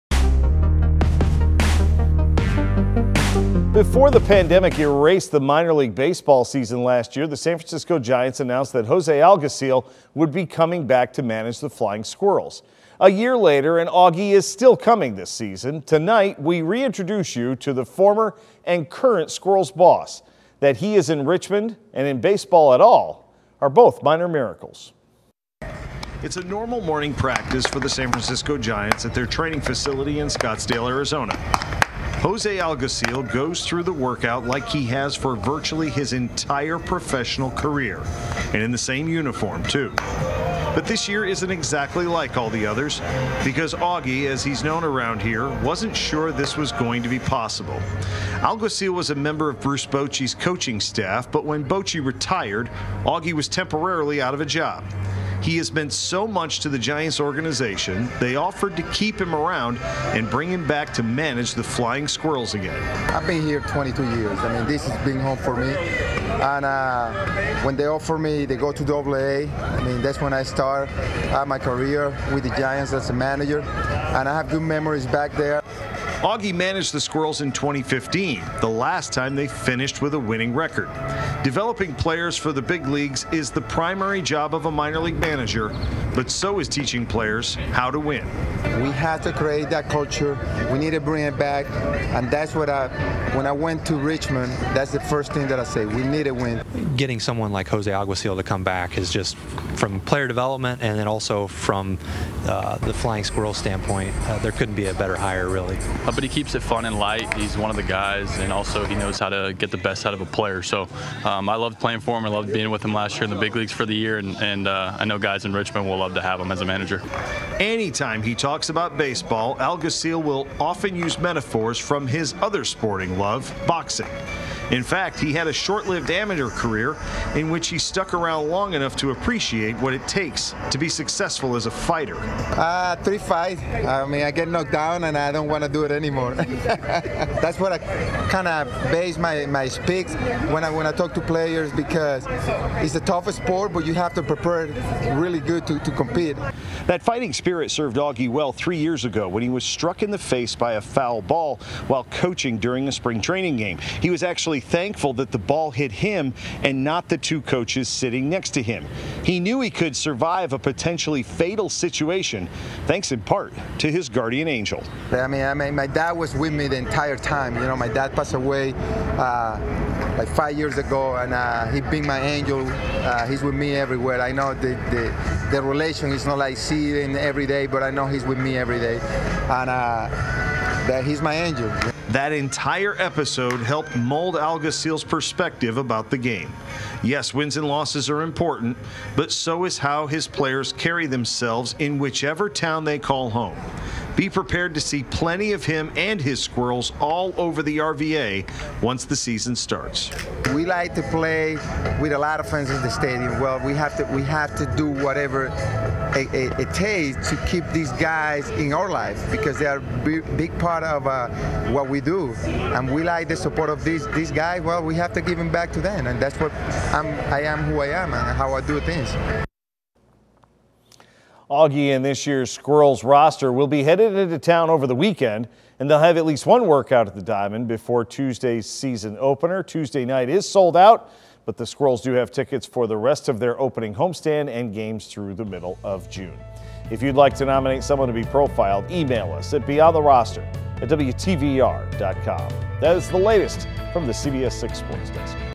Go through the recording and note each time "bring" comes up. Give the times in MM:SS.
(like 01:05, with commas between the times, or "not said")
01:00, 01:30.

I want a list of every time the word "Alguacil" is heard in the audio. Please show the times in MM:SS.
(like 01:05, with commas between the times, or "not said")
00:09, 00:32, 00:48, 01:37, 01:59.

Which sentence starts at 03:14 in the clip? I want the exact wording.
Be prepared to see plenty of him and his squirrels all over the RVA once the season starts.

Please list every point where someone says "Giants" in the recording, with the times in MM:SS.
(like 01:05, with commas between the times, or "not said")
00:07, 00:28, 00:56, 01:12.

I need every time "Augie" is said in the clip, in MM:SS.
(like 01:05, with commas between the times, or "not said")
00:13, 00:43, 00:53, 01:16, 02:27, 03:41.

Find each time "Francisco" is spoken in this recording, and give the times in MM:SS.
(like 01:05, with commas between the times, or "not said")
00:07, 00:28.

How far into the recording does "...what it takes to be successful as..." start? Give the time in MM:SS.
02:09.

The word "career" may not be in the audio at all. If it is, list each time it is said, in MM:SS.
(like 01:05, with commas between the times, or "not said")
00:37, 01:11, 02:06.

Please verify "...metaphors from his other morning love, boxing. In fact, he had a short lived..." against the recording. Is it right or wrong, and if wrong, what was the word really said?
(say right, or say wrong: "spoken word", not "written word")
wrong: "sporting", not "morning".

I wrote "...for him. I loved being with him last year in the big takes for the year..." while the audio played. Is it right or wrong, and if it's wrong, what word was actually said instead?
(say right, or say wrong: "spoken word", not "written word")
wrong: "leagues", not "takes".